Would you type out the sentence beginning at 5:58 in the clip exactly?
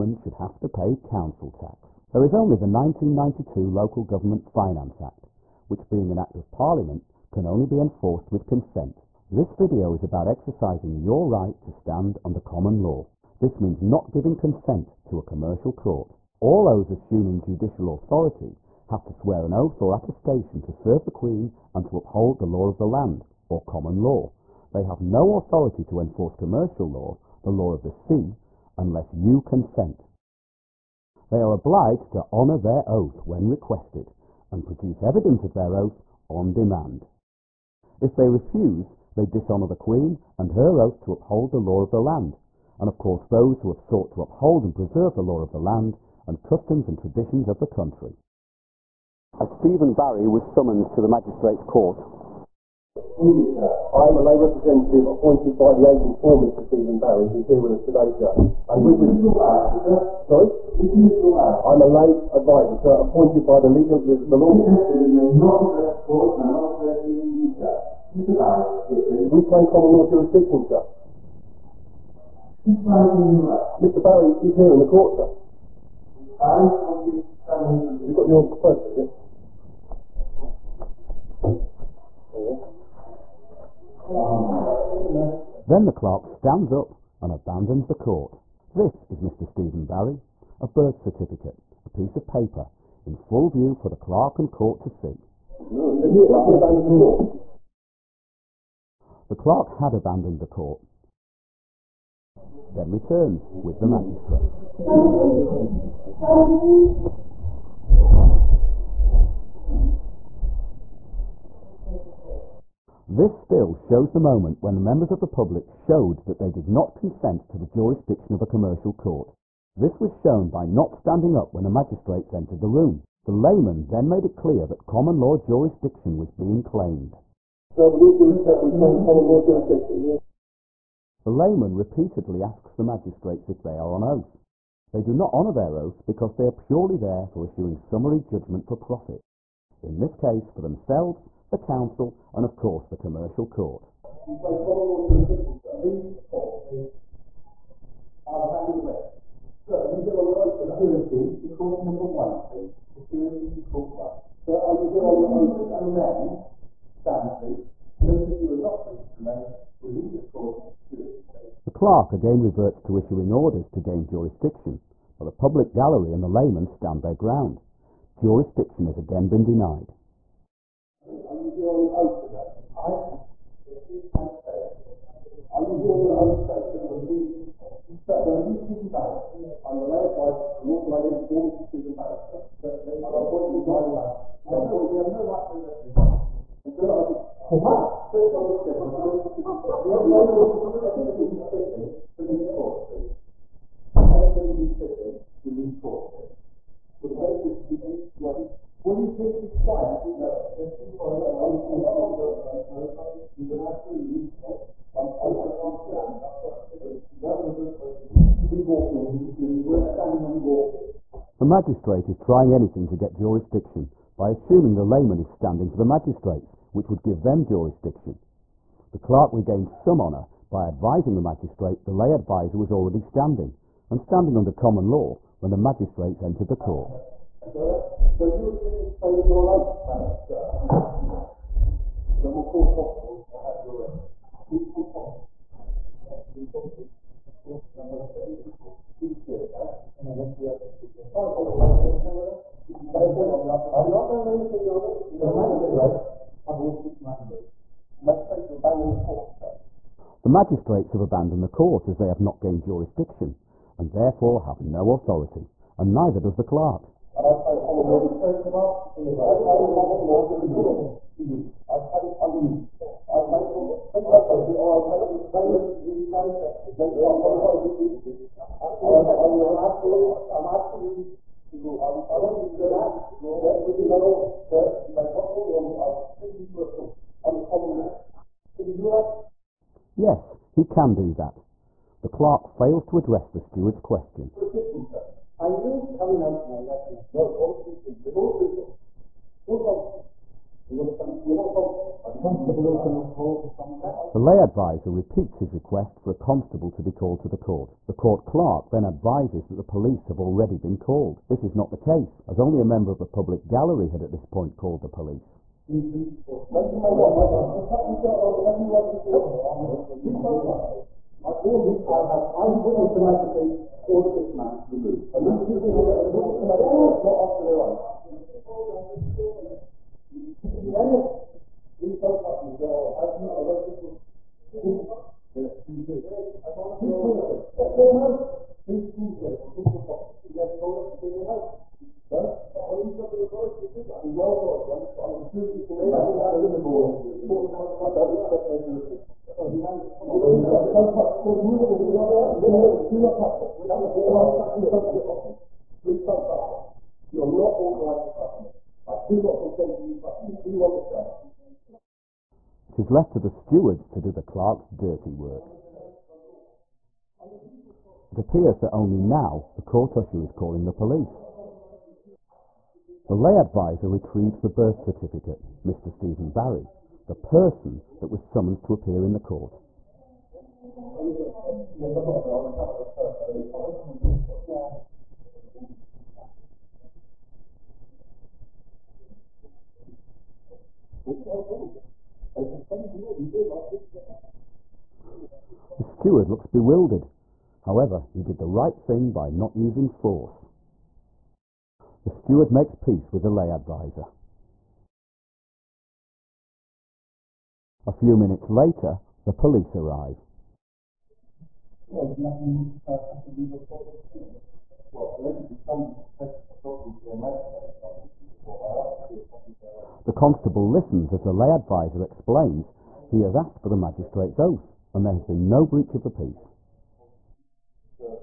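It appears that only now the court usher is calling the police.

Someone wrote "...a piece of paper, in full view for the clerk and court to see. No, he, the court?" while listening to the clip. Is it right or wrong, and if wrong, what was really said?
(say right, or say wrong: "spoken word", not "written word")
right.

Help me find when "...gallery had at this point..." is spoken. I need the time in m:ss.
5:03.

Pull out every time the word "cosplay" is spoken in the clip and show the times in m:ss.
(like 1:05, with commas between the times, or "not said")
not said.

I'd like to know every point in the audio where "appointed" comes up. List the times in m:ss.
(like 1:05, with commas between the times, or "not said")
0:55, 1:02.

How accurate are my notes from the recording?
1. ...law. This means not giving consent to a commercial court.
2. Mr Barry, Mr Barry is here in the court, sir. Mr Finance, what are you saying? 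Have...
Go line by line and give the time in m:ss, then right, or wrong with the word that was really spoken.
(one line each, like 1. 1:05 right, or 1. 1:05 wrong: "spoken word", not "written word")
1. 0:12 right
2. 1:12 wrong: "Barry", not "Finance".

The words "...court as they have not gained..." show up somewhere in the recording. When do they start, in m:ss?
4:11.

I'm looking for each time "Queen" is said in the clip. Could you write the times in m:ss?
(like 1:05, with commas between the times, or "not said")
0:21, 0:39.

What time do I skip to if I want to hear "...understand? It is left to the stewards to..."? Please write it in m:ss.
5:50.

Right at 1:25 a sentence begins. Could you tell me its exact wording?
Then the clerk stands up and abandons the court.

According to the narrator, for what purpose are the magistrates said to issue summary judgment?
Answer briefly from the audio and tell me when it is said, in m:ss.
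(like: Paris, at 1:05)
for profit, at 2:18.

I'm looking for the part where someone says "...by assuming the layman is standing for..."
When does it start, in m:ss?
3:34.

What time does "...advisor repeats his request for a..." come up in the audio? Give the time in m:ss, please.
4:54.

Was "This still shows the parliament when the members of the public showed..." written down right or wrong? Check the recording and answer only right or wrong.
wrong.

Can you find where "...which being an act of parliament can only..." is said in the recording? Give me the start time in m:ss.
0:05.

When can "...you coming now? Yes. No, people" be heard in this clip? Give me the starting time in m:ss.
4:45.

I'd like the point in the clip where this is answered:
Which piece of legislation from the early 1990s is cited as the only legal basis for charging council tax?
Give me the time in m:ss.
0:02.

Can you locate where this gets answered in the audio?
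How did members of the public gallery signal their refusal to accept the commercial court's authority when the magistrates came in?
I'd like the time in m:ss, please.
2:00.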